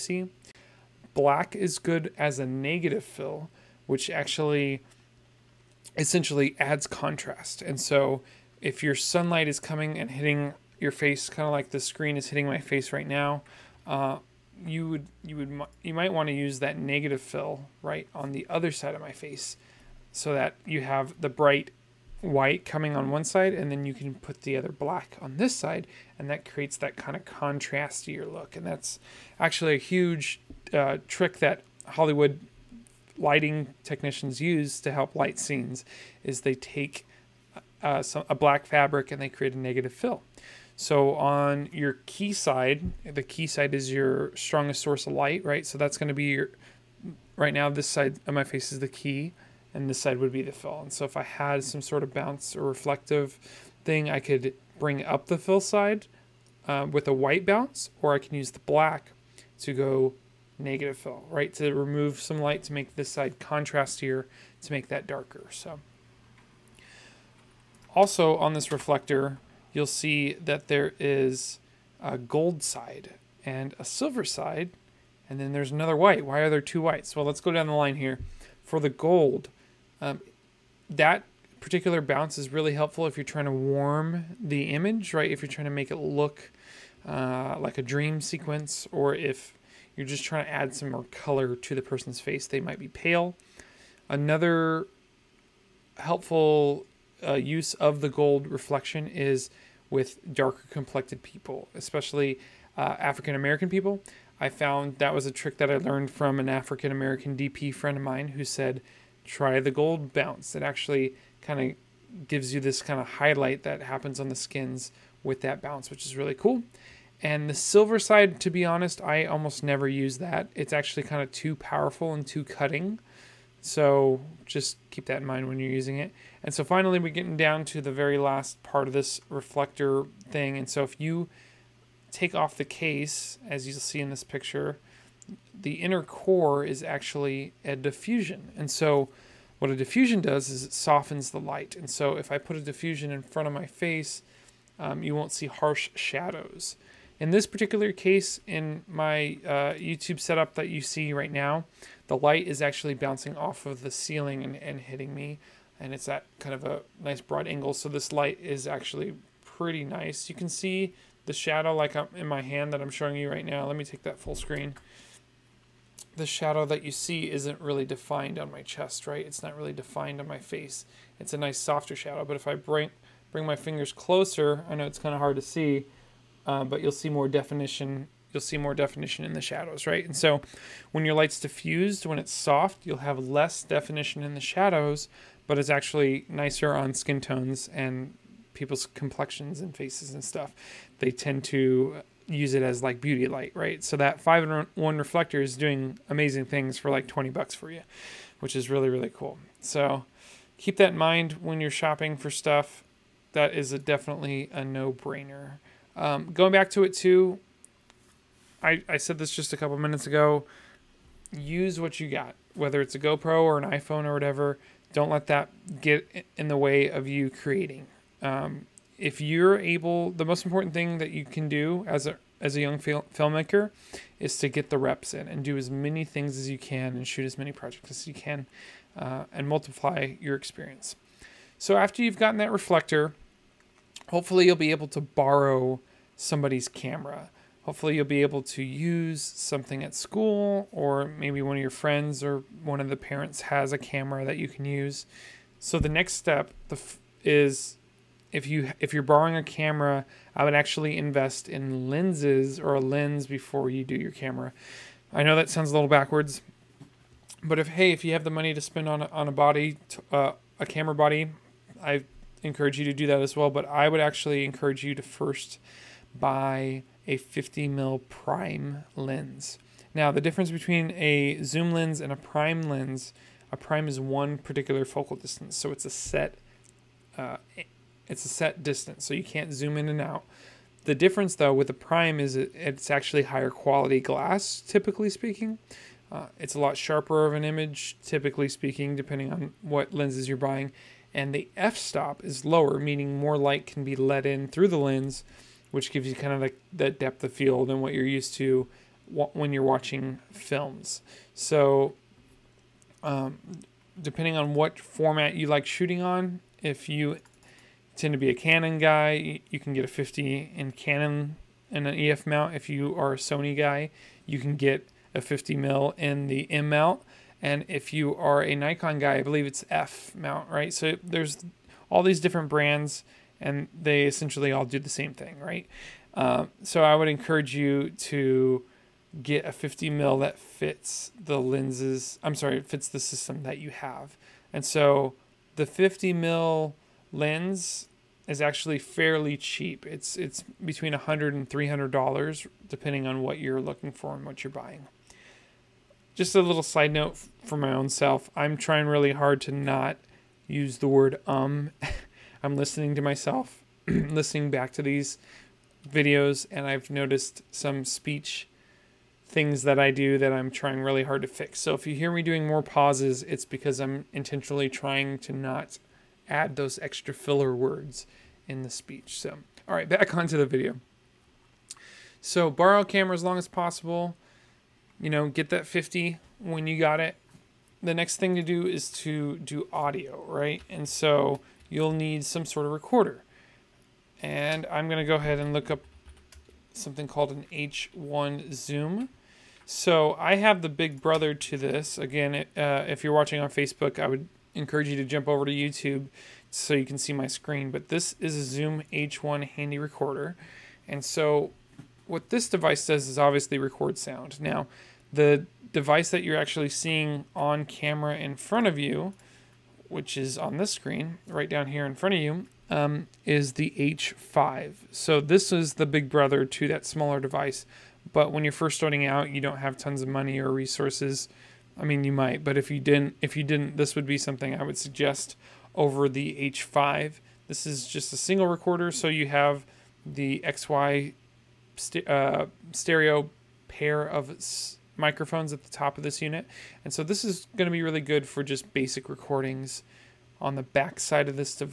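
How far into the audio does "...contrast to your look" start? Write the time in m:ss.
0:27.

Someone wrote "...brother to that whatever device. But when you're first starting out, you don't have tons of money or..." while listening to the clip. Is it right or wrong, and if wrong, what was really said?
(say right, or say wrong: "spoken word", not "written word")
wrong: "smaller", not "whatever".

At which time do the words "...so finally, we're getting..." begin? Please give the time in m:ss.
2:06.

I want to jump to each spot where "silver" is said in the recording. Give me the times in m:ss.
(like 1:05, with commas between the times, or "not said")
1:13, 1:57.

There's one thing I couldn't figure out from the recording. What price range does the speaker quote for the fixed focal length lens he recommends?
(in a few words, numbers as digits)
$100 to $300.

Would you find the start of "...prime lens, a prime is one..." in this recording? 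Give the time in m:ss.
4:32.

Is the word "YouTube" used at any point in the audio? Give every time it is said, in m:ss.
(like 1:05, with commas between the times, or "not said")
2:29, 6:35.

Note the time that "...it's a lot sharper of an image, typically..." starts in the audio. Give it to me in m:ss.
4:46.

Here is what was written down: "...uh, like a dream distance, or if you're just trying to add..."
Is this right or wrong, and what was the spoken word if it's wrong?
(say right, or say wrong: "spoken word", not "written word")
wrong: "sequence", not "distance".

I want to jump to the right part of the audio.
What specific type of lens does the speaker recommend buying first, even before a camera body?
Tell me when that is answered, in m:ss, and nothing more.
4:27.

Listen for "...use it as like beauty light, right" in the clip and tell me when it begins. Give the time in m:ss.
3:12.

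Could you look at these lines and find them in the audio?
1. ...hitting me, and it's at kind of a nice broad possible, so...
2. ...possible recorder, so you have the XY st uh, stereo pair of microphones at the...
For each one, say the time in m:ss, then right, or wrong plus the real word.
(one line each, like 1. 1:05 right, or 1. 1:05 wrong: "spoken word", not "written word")
1. 2:34 wrong: "angle", not "possible"
2. 7:08 wrong: "single", not "possible".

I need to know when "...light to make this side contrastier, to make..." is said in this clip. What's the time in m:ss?
1:02.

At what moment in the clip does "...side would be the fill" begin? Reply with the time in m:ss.
0:49.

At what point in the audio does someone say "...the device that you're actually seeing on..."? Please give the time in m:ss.
6:45.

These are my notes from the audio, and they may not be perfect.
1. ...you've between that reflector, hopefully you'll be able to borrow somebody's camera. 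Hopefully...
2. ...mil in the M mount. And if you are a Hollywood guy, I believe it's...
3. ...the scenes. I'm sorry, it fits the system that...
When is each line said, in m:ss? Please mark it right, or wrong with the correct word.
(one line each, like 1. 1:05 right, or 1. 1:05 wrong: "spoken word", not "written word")
1. 3:52 wrong: "gotten", not "between"
2. 5:15 wrong: "Nikon", not "Hollywood"
3. 5:31 wrong: "lenses", not "scenes".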